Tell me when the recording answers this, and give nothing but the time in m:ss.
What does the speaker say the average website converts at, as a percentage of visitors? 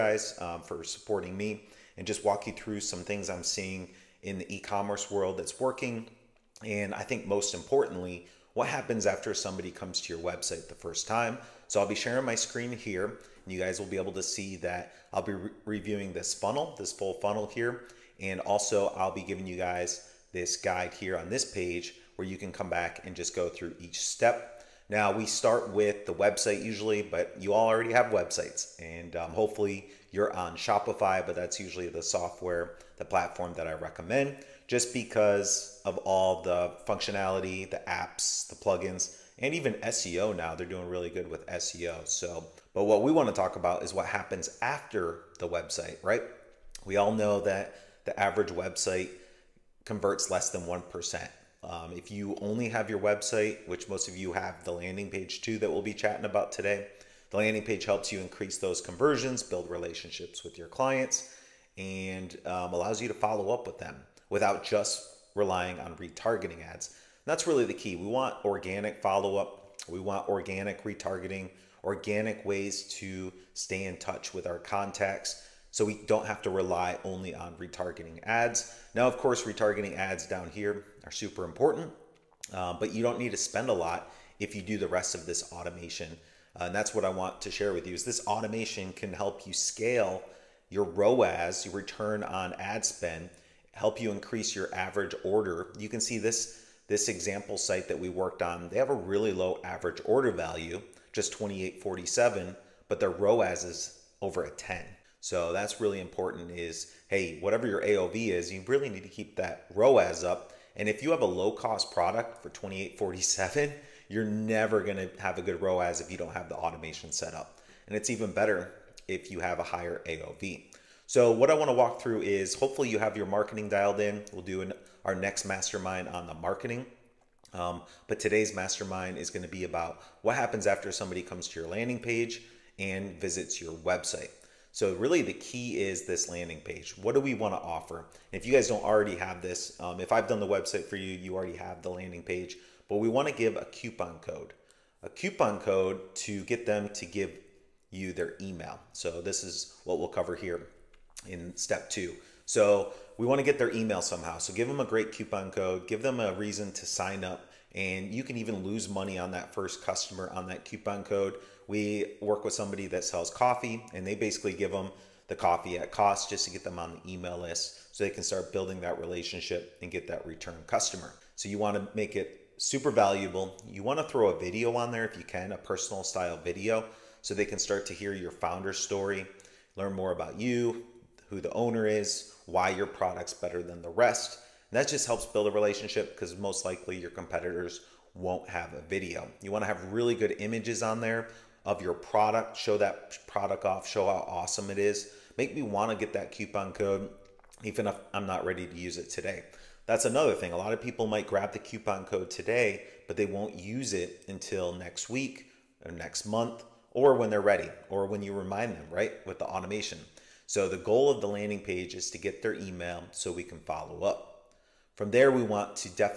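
0:50.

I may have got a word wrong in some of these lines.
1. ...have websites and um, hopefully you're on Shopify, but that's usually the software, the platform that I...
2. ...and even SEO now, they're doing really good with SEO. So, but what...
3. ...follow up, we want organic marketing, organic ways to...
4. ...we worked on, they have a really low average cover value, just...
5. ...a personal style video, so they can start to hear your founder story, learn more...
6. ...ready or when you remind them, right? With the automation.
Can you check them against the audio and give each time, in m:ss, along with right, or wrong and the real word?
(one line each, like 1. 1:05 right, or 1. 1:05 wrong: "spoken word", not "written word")
1. 0:27 right
2. 0:39 right
3. 1:09 wrong: "retargeting", not "marketing"
4. 1:37 wrong: "order", not "cover"
5. 2:55 right
6. 3:27 right.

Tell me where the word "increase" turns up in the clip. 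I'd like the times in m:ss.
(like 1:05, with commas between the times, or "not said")
0:58, 1:34.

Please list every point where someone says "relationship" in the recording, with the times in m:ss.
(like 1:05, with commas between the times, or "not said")
0:59, 2:48, 3:05.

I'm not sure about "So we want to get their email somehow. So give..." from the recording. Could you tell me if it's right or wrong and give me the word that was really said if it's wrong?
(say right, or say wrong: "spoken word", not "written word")
right.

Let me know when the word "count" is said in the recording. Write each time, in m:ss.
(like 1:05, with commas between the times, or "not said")
not said.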